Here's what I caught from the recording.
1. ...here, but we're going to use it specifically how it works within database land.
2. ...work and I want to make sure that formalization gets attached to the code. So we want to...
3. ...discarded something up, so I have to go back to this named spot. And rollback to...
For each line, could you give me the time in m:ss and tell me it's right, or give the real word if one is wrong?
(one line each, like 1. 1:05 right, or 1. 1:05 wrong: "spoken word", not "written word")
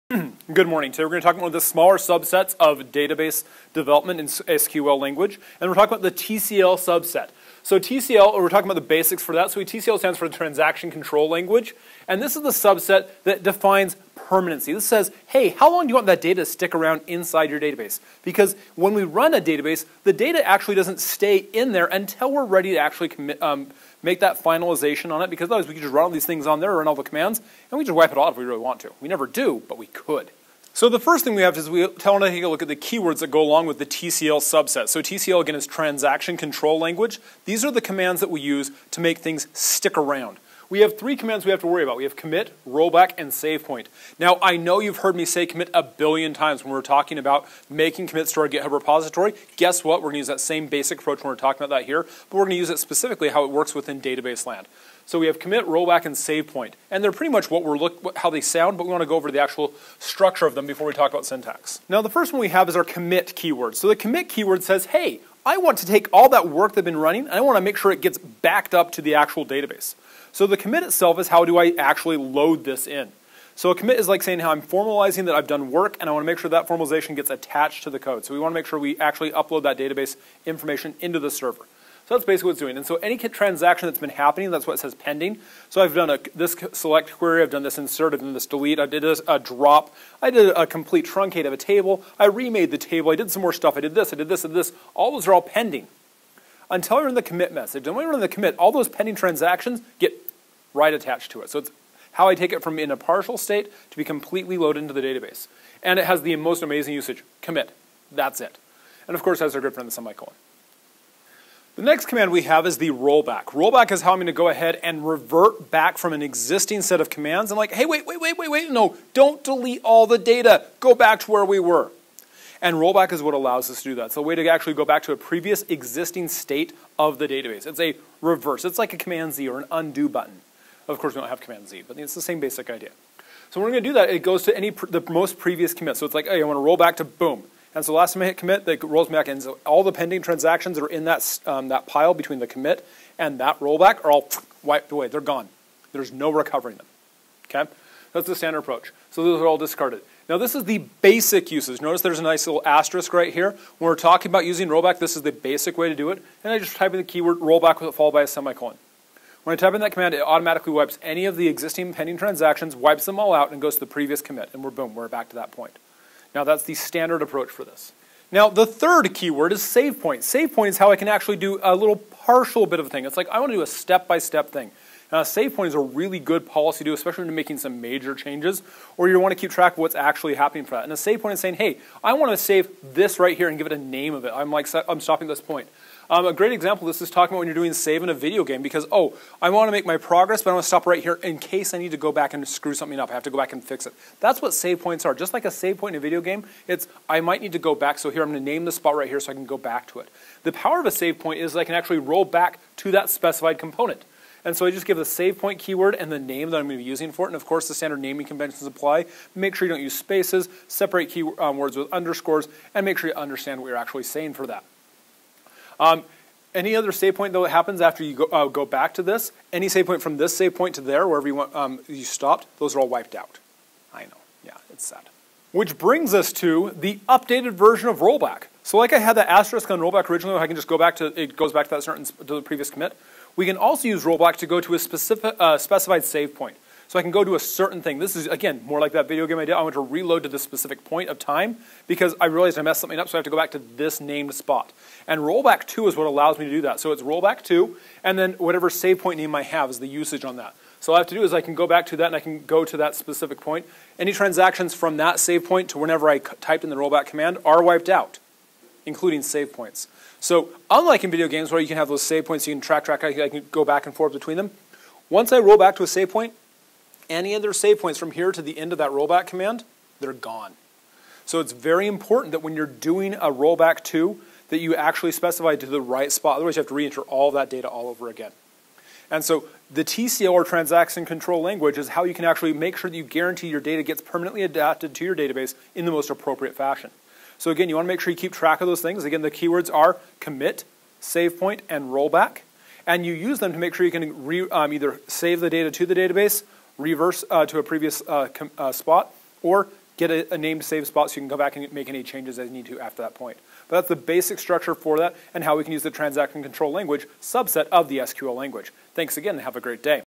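1. 0:51 right
2. 1:15 right
3. 4:02 wrong: "messed", not "discarded".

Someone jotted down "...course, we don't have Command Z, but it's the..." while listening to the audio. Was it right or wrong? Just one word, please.
right.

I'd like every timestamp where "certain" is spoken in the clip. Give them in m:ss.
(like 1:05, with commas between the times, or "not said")
3:51, 3:57.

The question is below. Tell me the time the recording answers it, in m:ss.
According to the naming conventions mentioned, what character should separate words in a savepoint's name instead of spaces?
3:31.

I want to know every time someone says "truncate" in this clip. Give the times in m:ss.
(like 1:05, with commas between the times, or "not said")
1:31.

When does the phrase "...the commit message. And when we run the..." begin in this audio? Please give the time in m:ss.
1:37.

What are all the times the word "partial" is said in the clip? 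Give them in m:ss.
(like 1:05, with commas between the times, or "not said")
1:42, 2:51.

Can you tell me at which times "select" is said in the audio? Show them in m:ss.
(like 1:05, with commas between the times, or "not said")
1:26.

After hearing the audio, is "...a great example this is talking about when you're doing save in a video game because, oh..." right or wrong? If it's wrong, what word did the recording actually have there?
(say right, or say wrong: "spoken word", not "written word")
right.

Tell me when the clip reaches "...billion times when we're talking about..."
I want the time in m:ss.
0:45.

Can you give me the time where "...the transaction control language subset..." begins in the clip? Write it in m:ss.
5:05.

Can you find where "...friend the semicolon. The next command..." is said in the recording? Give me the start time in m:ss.
1:49.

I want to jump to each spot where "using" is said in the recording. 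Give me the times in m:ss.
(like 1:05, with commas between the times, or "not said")
2:34, 3:26.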